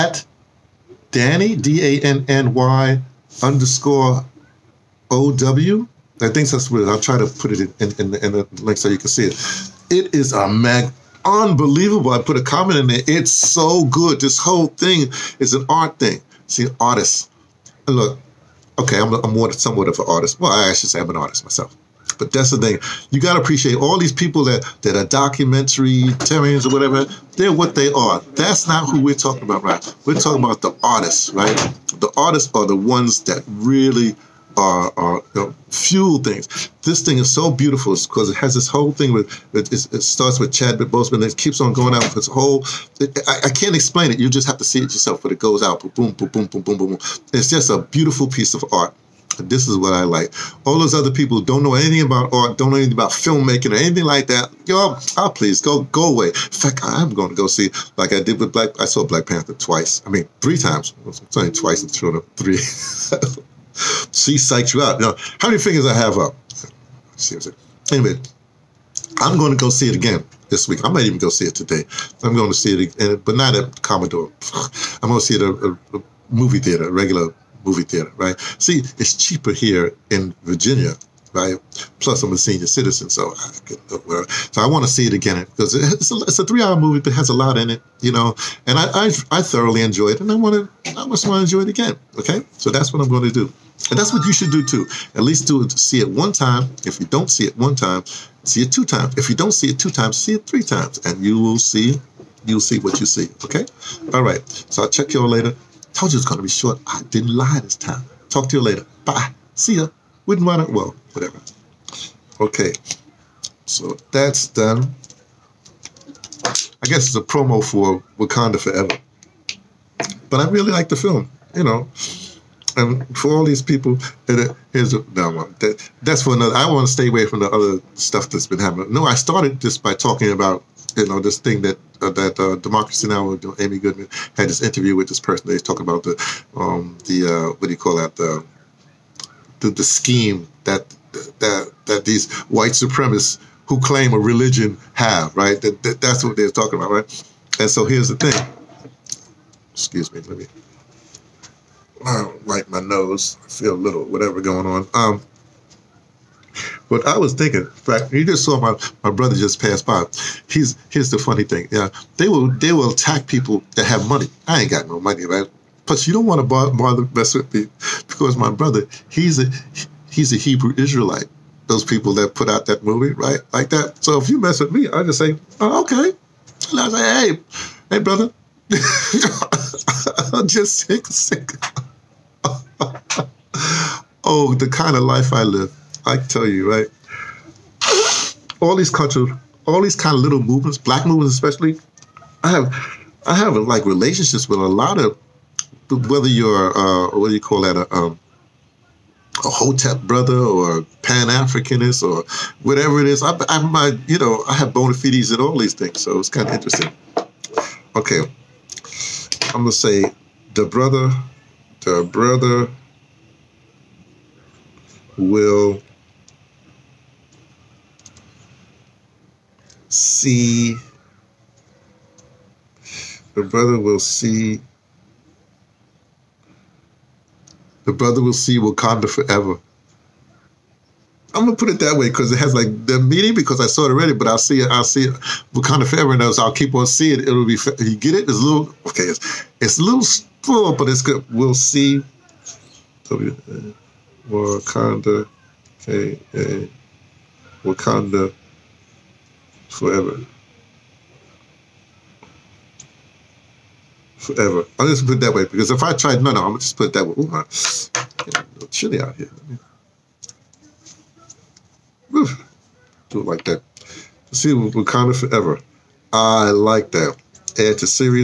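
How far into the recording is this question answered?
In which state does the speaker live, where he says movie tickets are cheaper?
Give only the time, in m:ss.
1:20.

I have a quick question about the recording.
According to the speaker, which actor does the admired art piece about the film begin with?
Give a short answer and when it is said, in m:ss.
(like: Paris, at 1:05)
Chadwick Boseman, at 0:40.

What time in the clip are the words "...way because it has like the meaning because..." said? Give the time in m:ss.
3:51.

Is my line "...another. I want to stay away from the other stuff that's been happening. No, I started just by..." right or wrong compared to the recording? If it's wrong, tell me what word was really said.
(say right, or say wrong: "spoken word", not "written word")
right.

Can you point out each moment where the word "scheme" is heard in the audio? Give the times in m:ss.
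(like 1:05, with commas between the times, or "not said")
2:19.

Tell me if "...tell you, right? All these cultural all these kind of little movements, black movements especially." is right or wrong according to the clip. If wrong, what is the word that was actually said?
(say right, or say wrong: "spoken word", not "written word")
right.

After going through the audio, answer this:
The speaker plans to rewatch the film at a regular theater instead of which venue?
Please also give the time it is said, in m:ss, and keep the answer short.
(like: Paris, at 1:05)
Commodore, at 1:13.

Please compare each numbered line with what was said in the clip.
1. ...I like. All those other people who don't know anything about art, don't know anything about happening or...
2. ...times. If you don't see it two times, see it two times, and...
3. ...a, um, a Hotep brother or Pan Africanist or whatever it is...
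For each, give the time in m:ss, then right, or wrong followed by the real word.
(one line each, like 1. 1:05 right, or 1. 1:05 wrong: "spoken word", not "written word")
1. 0:49 wrong: "filmmaking", not "happening"
2. 1:38 wrong: "three", not "two"
3. 3:17 right.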